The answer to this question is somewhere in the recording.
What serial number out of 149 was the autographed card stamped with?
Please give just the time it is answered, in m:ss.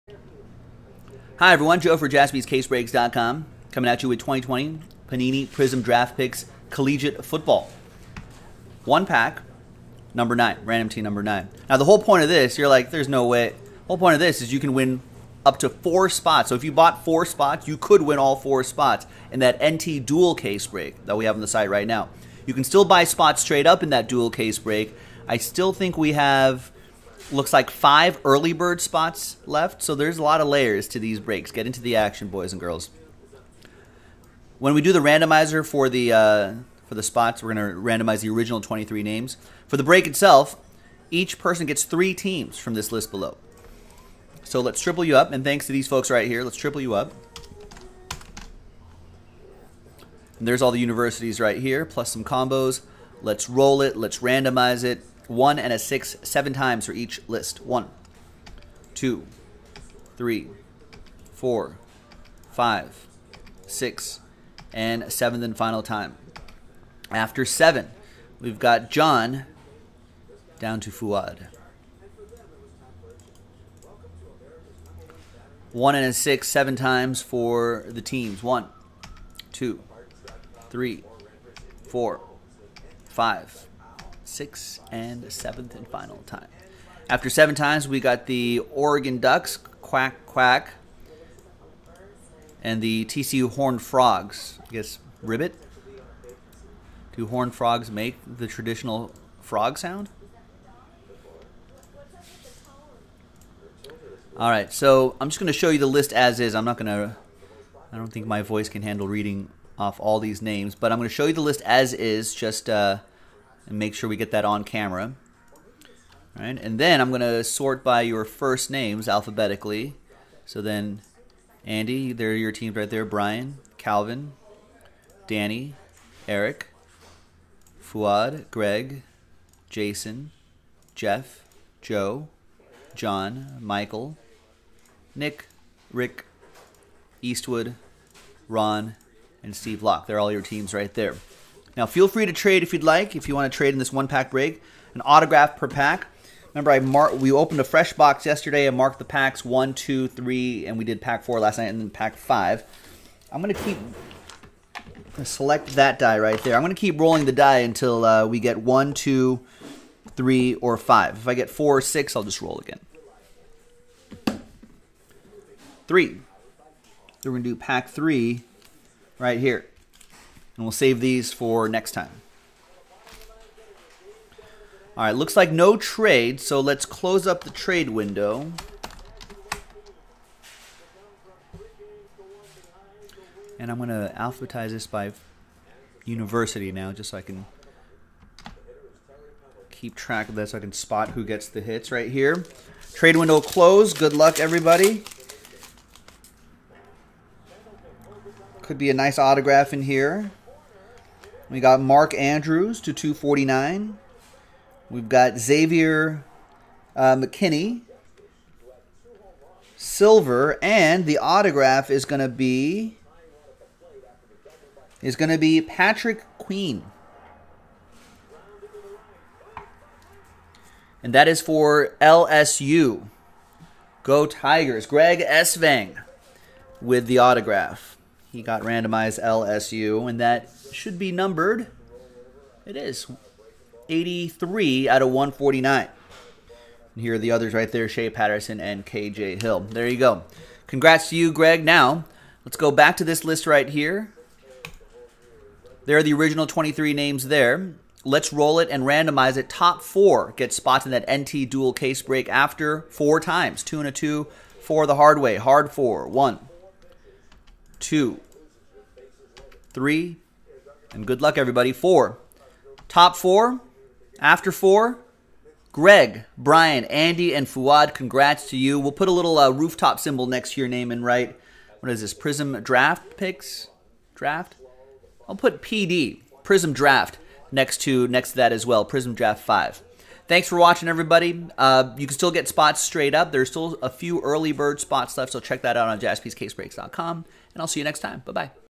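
3:53.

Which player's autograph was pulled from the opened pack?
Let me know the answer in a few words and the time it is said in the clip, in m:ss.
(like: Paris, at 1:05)
Patrick Queen, at 3:35.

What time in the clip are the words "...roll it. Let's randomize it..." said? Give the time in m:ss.
0:53.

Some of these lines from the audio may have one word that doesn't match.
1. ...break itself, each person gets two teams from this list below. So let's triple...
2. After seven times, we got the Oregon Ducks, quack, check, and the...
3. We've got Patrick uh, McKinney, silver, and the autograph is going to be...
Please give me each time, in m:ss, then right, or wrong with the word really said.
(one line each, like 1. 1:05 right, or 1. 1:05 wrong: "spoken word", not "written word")
1. 0:39 wrong: "three", not "two"
2. 1:27 wrong: "quack", not "check"
3. 3:24 wrong: "Xavier", not "Patrick".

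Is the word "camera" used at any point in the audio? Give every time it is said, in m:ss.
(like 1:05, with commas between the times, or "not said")
1:54.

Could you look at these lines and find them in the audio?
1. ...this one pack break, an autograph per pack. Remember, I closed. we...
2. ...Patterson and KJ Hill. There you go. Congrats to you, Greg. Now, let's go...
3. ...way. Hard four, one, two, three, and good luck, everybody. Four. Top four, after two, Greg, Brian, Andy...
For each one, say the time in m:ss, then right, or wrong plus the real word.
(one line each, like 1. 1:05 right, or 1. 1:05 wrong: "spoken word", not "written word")
1. 2:23 wrong: "marked", not "closed"
2. 3:58 right
3. 4:15 wrong: "four", not "two".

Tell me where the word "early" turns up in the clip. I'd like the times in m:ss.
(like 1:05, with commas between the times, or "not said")
0:28, 4:44.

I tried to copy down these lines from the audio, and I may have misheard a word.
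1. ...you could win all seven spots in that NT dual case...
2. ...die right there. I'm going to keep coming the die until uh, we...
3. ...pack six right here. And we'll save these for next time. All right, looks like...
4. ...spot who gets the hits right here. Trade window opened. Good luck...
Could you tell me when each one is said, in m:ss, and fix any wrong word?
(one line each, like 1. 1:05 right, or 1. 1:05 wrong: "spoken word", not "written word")
1. 0:17 wrong: "four", not "seven"
2. 2:35 wrong: "rolling", not "coming"
3. 2:47 wrong: "three", not "six"
4. 3:10 wrong: "closed", not "opened".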